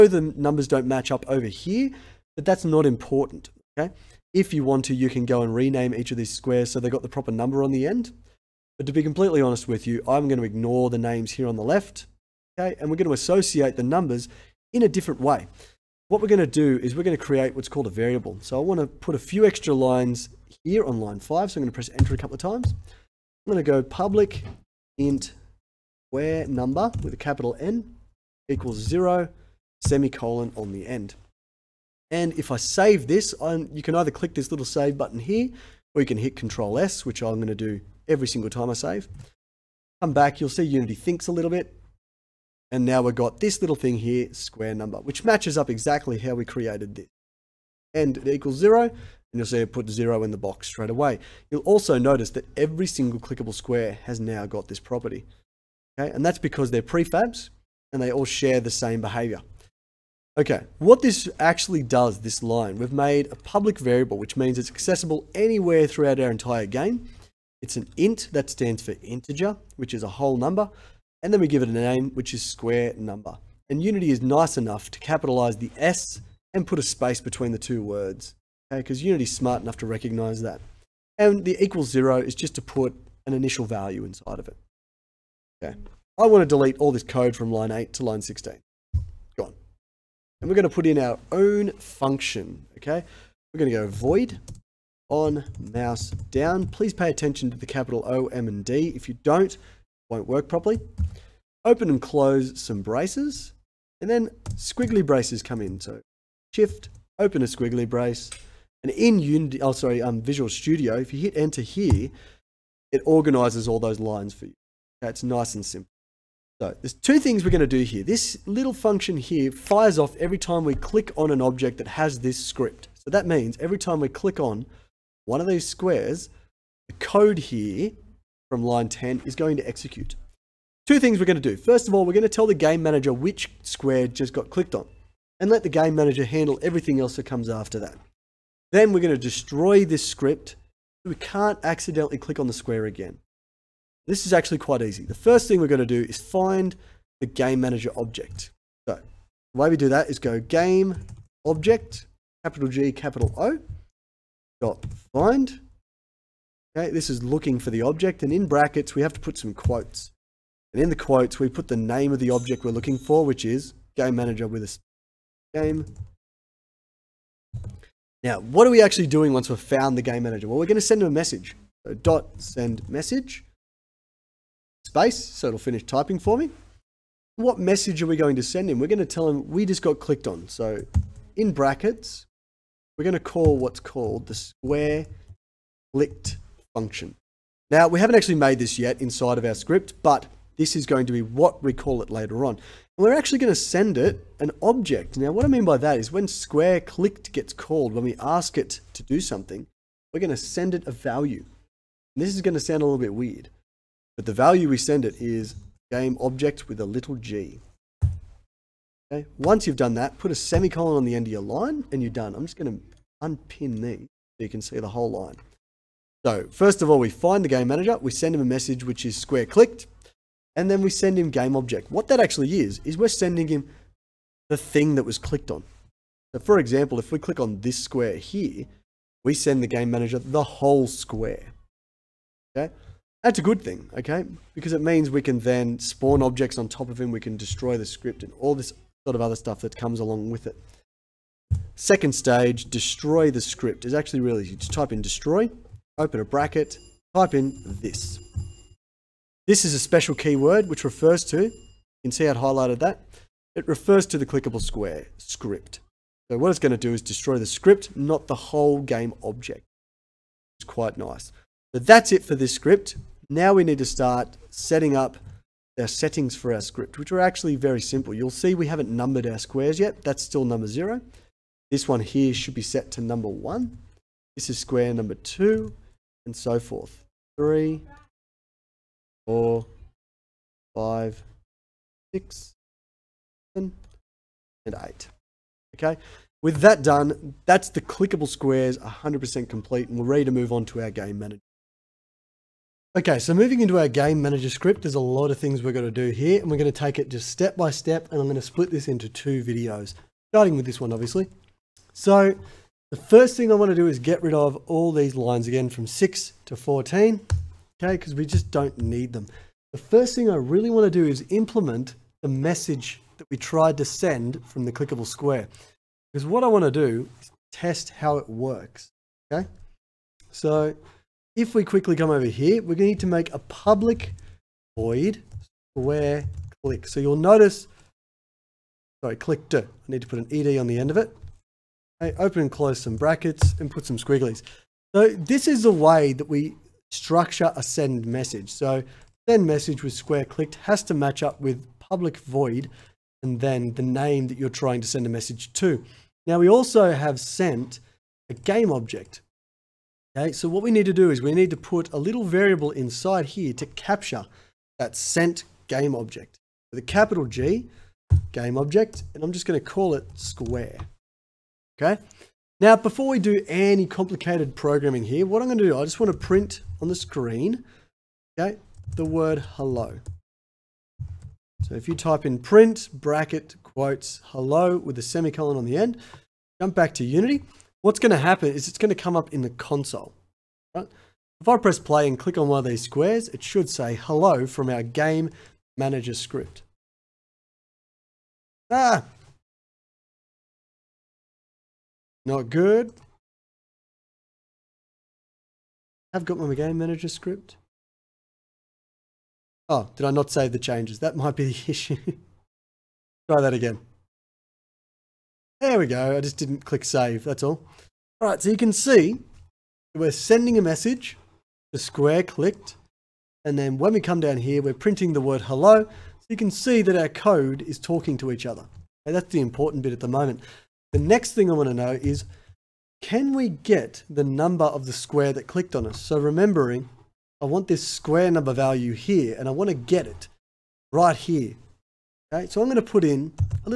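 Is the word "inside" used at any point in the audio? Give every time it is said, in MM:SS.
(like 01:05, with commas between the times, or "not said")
01:24, 03:09, 05:52.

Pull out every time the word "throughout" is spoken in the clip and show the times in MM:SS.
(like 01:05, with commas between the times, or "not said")
01:05.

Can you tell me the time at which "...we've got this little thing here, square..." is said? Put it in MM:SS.
00:43.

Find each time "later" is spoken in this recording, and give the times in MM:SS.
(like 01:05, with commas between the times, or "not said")
03:12.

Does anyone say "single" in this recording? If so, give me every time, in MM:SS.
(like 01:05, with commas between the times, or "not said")
00:38, 00:52.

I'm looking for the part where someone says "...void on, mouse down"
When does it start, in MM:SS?
01:33.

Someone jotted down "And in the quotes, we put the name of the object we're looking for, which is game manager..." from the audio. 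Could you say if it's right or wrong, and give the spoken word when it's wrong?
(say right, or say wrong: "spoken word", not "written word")
right.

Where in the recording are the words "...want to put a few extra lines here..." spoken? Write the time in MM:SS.
00:18.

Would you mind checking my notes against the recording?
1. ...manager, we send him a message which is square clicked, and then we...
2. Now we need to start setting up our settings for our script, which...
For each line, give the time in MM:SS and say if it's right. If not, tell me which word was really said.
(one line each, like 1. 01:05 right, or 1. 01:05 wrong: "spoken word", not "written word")
1. 03:37 right
2. 04:23 right.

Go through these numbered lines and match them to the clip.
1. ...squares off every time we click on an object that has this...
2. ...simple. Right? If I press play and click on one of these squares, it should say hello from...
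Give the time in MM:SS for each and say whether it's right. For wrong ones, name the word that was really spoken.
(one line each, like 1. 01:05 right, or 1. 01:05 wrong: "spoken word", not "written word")
1. 01:59 wrong: "fires", not "squares"
2. 06:19 wrong: "console", not "simple".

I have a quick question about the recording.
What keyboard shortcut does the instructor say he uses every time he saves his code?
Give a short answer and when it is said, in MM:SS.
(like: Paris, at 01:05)
Control S, at 00:36.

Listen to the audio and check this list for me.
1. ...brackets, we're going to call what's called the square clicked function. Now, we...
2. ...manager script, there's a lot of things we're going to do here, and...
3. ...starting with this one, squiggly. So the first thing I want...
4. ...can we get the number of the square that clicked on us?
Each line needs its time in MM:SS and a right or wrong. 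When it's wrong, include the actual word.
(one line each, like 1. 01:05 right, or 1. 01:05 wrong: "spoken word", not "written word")
1. 03:01 right
2. 04:54 right
3. 05:00 wrong: "obviously", not "squiggly"
4. 07:03 right.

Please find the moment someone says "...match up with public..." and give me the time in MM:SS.
05:40.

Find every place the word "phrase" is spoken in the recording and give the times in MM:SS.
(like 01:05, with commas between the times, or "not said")
not said.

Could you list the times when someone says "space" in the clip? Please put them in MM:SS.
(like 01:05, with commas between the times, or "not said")
01:16, 02:54.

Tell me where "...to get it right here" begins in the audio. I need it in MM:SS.
07:09.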